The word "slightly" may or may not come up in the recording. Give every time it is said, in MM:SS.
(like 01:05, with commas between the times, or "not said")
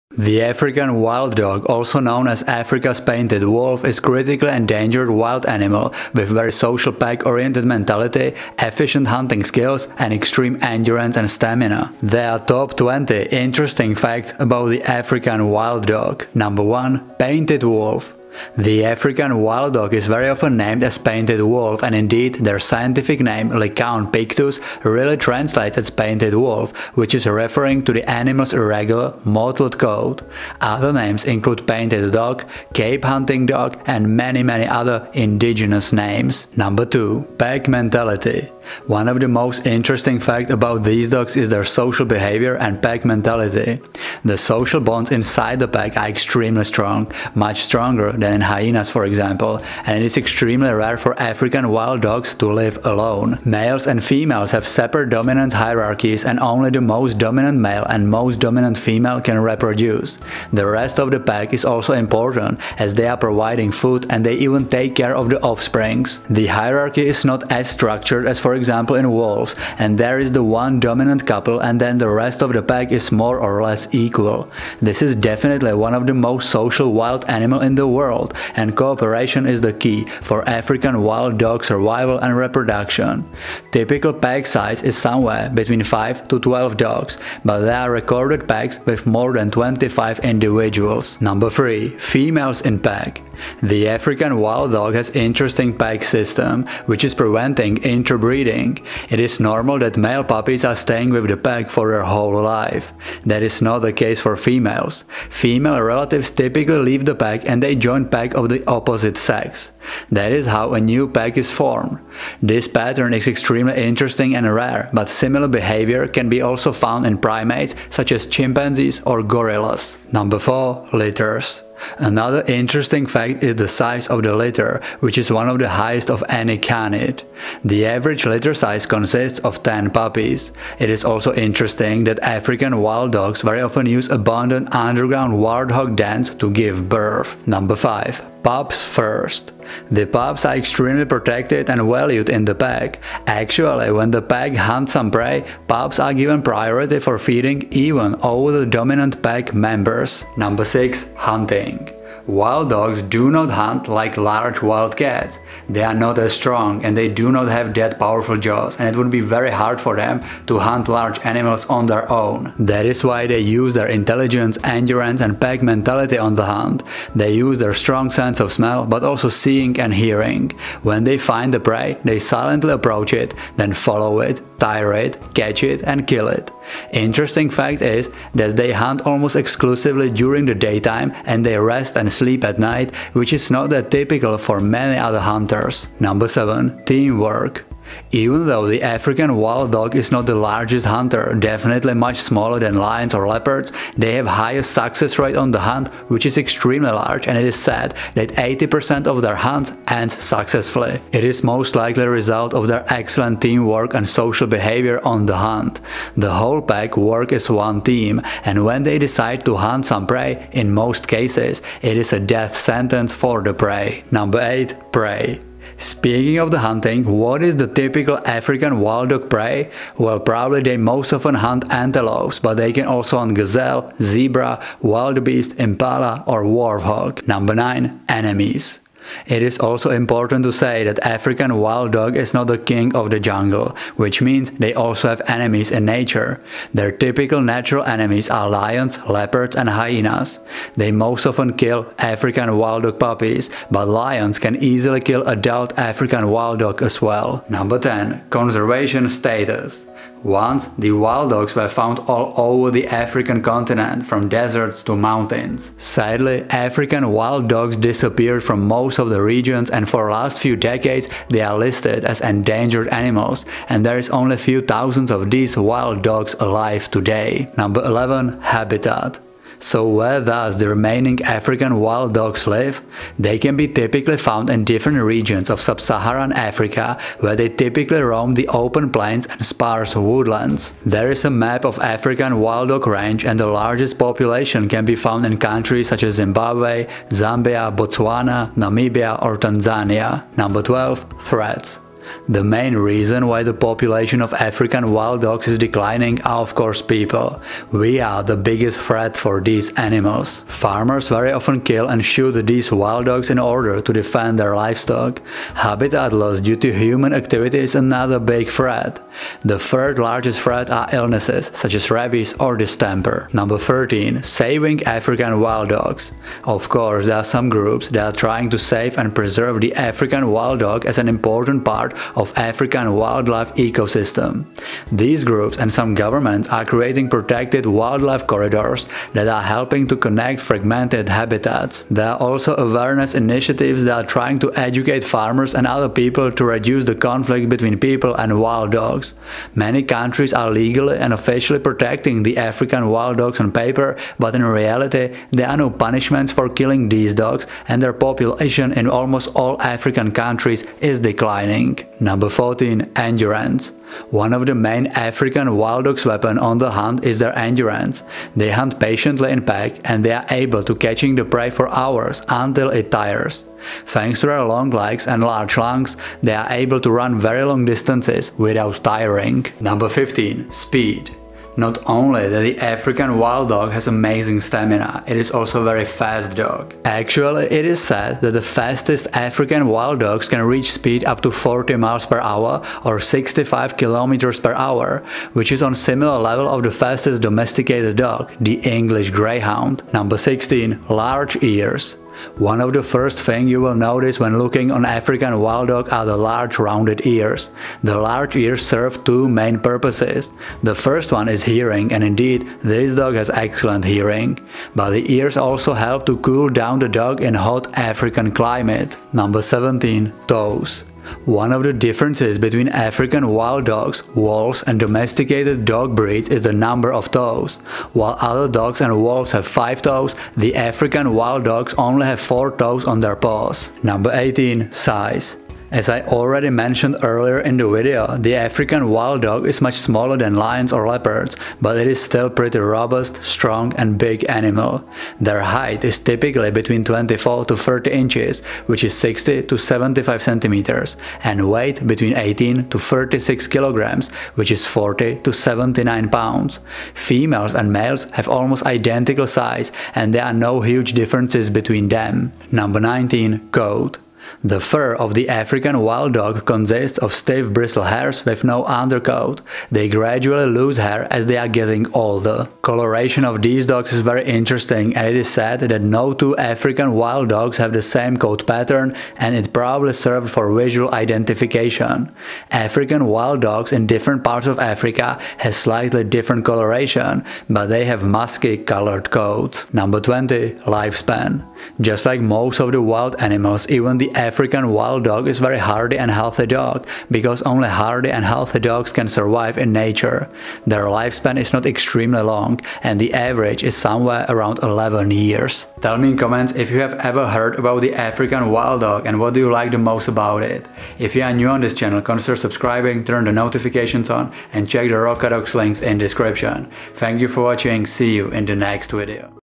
07:55.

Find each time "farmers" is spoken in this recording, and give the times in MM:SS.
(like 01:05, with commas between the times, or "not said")
05:00, 05:35.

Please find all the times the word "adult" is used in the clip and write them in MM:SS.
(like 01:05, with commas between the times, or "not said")
04:05.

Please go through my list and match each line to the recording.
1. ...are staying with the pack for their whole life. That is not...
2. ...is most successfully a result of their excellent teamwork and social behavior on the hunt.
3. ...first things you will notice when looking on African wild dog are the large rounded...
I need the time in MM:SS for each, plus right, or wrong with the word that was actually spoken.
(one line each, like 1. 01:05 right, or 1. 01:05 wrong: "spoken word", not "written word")
1. 01:40 right
2. 03:21 wrong: "likely", not "successfully"
3. 06:32 right.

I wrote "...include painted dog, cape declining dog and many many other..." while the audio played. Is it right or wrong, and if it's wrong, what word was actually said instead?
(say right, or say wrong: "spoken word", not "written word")
wrong: "hunting", not "declining".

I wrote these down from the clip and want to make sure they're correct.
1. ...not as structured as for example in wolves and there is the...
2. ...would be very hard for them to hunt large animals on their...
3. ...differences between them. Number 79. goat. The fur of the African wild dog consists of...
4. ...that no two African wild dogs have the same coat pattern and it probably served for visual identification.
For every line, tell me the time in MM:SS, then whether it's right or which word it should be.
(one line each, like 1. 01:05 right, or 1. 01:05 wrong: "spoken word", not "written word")
1. 01:07 right
2. 02:38 right
3. 07:30 wrong: "19", not "79"
4. 07:45 right.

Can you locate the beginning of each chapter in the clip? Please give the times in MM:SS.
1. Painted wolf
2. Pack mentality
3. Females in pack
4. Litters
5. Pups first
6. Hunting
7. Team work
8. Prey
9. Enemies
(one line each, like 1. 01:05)
1. 00:18
2. 00:38
3. 01:33
4. 02:00
5. 02:18
6. 02:33
7. 03:06
8. 03:35
9. 03:47.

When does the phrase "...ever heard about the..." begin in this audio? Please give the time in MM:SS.
08:16.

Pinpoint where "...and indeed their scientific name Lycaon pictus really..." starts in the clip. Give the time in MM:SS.
00:21.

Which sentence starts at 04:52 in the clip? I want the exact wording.
The main reason why the population of African wild dogs is declining are of course people.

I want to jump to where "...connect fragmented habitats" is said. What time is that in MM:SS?
05:29.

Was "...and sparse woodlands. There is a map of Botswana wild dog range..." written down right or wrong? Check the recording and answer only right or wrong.
wrong.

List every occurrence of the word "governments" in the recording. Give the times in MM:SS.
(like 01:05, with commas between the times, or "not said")
05:25.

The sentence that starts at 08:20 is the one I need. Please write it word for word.
If you are new on this channel, consider subscribing, turn the notifications on, and check the Rocadog's links in description.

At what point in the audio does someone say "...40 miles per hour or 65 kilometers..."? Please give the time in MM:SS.
06:21.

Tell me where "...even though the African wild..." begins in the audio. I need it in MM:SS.
03:08.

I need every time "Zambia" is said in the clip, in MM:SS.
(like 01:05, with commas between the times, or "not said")
04:47.